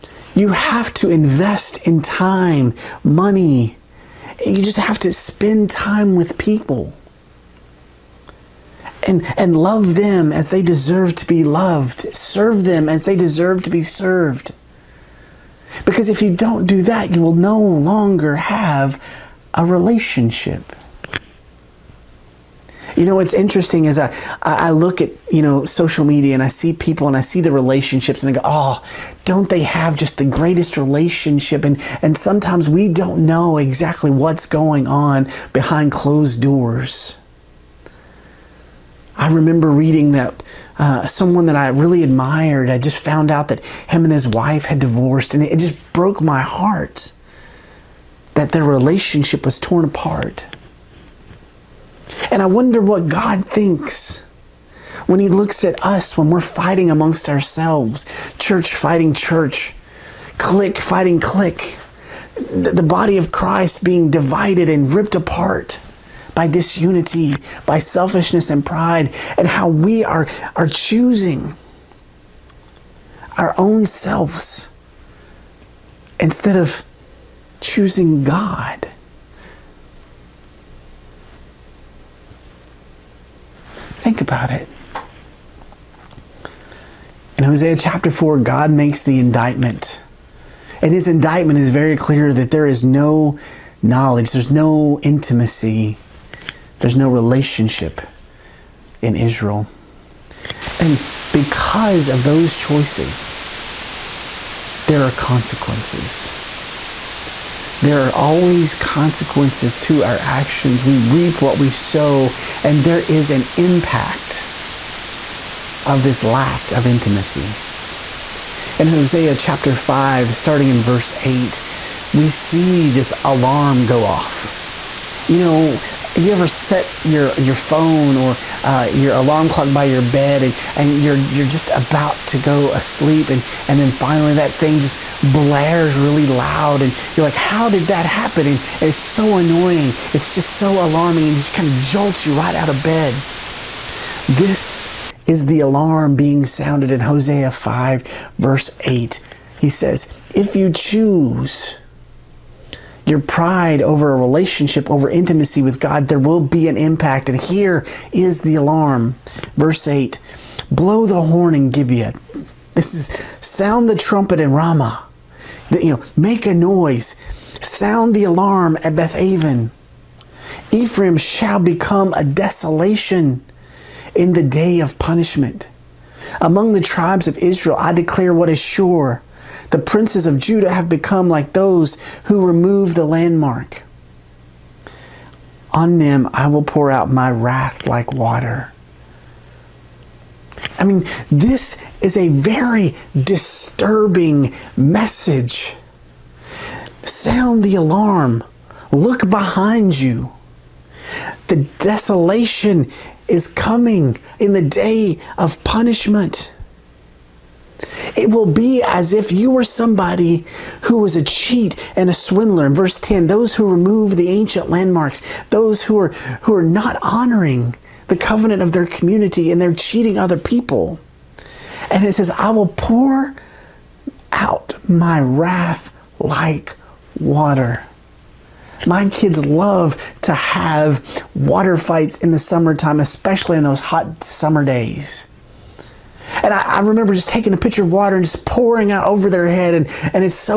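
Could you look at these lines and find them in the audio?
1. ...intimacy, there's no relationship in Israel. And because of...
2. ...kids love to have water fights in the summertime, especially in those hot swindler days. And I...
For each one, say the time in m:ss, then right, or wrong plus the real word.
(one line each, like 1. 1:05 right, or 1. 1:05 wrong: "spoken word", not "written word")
1. 1:35 right
2. 3:49 wrong: "summer", not "swindler".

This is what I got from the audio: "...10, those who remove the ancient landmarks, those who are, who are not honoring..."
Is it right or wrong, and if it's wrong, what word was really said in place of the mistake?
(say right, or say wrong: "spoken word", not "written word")
right.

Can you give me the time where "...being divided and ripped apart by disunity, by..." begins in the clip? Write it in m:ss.
1:03.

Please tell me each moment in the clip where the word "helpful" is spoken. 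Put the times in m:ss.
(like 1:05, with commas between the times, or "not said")
not said.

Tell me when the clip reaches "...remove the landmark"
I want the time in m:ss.
3:02.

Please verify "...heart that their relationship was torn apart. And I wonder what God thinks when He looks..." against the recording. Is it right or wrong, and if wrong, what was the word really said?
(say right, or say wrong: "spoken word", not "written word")
right.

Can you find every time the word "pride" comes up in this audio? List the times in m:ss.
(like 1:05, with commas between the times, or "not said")
1:08, 2:33.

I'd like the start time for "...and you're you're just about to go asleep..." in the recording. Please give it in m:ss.
2:10.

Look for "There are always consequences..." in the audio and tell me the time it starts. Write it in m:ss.
1:47.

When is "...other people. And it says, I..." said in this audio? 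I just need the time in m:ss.
3:40.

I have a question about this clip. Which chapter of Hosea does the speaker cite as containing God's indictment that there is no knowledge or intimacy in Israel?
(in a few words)
Chapter 4.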